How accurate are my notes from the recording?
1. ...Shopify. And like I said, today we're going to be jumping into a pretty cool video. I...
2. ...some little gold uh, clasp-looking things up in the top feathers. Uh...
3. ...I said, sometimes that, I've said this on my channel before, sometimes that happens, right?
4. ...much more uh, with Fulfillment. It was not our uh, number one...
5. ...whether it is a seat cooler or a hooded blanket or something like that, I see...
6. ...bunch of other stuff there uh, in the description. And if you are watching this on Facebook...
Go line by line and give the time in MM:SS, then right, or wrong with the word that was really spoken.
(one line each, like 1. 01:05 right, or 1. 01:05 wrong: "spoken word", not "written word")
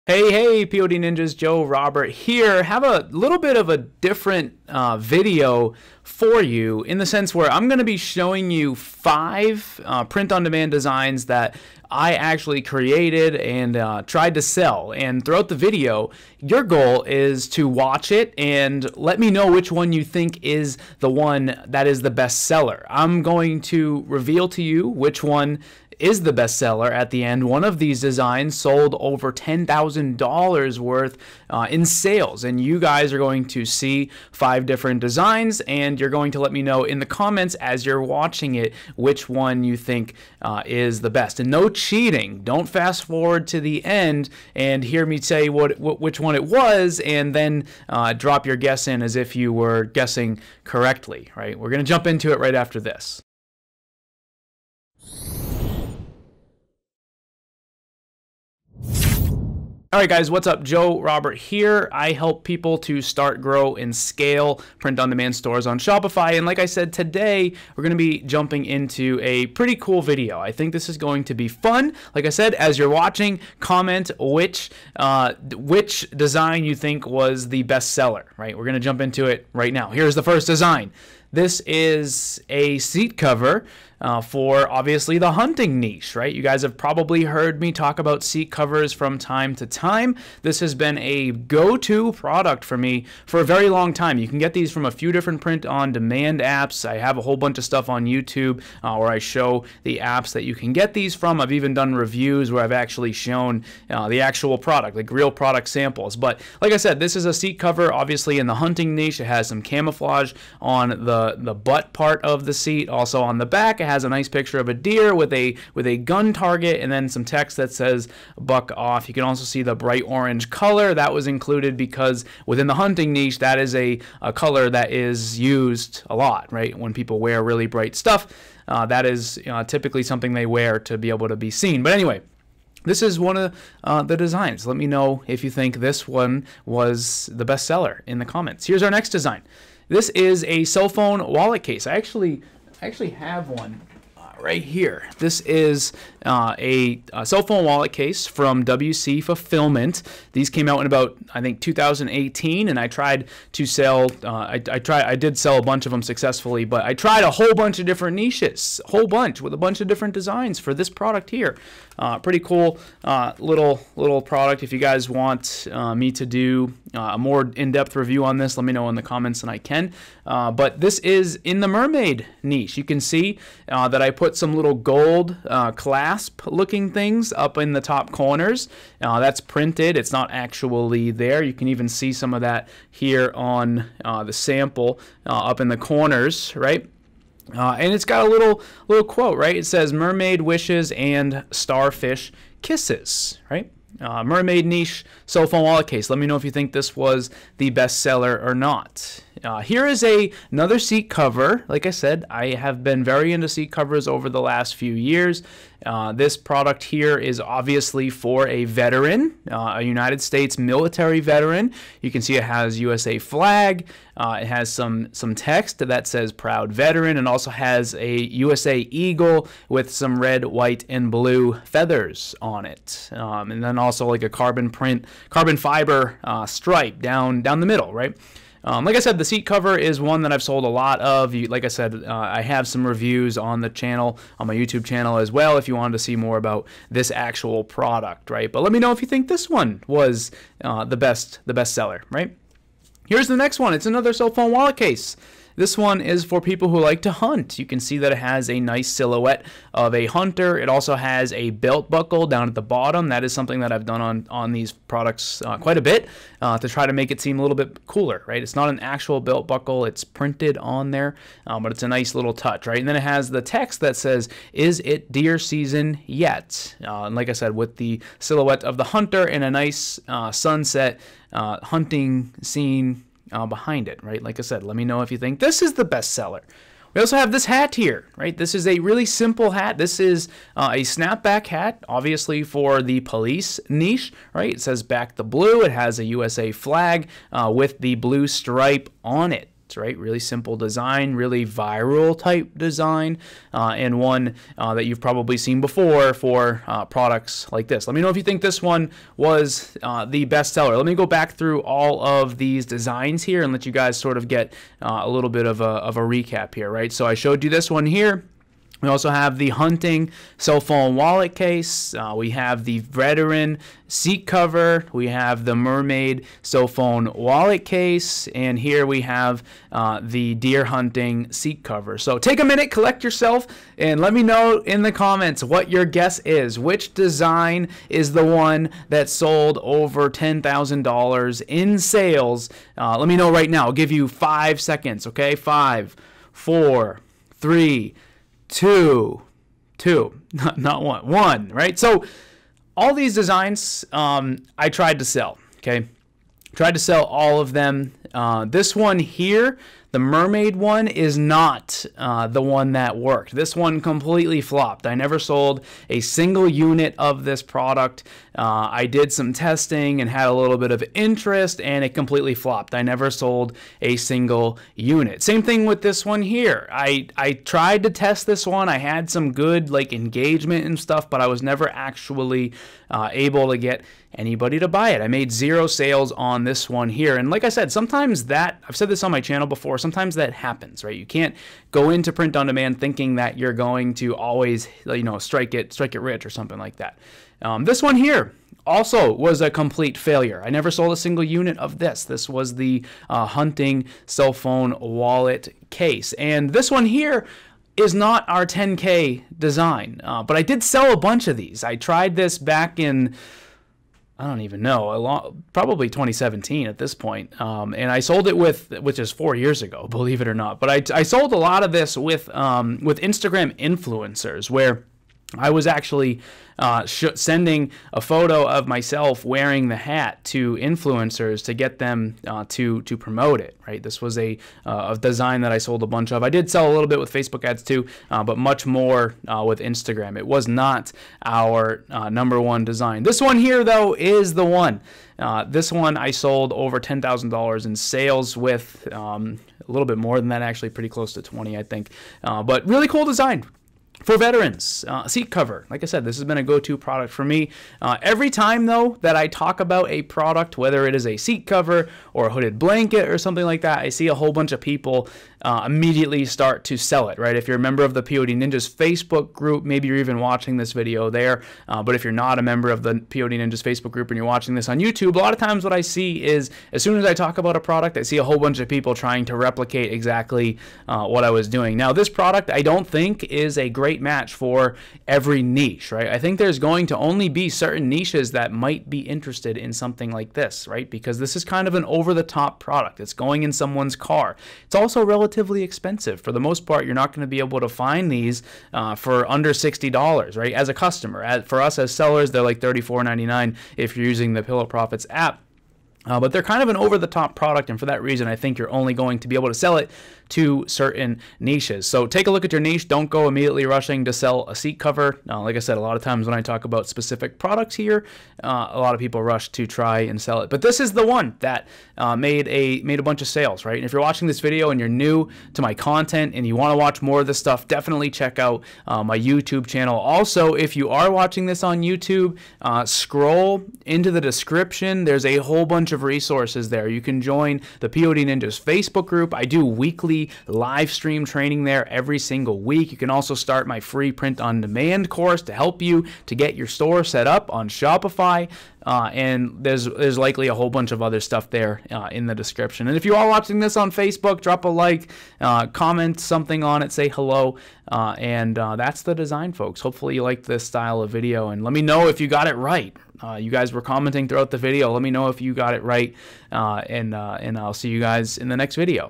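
1. 01:05 right
2. 02:54 wrong: "corners", not "feathers"
3. 06:17 right
4. 07:08 wrong: "Instagram", not "Fulfillment"
5. 07:30 wrong: "cover", not "cooler"
6. 09:00 right.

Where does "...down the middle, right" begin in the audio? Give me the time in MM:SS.
03:47.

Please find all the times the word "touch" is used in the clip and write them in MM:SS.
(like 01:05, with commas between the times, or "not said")
04:22.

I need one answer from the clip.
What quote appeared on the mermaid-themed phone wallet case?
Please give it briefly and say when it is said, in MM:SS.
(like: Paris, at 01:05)
Mermaid wishes and starfish kisses, at 03:09.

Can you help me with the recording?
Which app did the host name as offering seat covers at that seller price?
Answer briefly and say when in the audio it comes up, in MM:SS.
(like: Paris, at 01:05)
Pillow Profits, at 08:14.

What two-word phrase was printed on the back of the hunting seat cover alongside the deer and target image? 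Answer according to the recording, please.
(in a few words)
Buck off.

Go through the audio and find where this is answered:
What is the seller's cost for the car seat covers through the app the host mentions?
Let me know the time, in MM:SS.
08:12.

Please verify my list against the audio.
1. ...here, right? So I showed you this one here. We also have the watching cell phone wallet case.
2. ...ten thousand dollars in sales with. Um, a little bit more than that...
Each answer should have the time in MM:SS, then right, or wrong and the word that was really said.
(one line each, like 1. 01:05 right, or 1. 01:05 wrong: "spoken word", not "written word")
1. 05:06 wrong: "hunting", not "watching"
2. 07:16 right.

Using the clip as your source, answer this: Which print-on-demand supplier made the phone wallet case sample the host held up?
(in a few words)
WC Fulfillment.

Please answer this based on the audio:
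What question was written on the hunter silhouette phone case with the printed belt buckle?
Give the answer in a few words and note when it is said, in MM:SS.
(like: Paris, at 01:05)
Is it deer season yet?, at 04:24.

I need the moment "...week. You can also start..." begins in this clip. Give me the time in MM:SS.
08:52.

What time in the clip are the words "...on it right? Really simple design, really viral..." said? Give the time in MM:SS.
04:49.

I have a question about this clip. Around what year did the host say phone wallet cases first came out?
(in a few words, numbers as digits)
2018.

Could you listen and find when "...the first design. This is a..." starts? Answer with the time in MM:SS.
01:20.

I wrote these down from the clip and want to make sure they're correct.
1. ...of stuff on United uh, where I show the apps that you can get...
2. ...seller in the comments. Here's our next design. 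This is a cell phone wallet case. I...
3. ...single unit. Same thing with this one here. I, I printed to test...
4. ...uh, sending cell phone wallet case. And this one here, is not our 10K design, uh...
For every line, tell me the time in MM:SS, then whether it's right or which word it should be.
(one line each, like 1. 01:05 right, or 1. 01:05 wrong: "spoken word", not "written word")
1. 01:37 wrong: "YouTube", not "United"
2. 02:17 right
3. 06:03 wrong: "tried", not "printed"
4. 06:33 wrong: "hunting", not "sending".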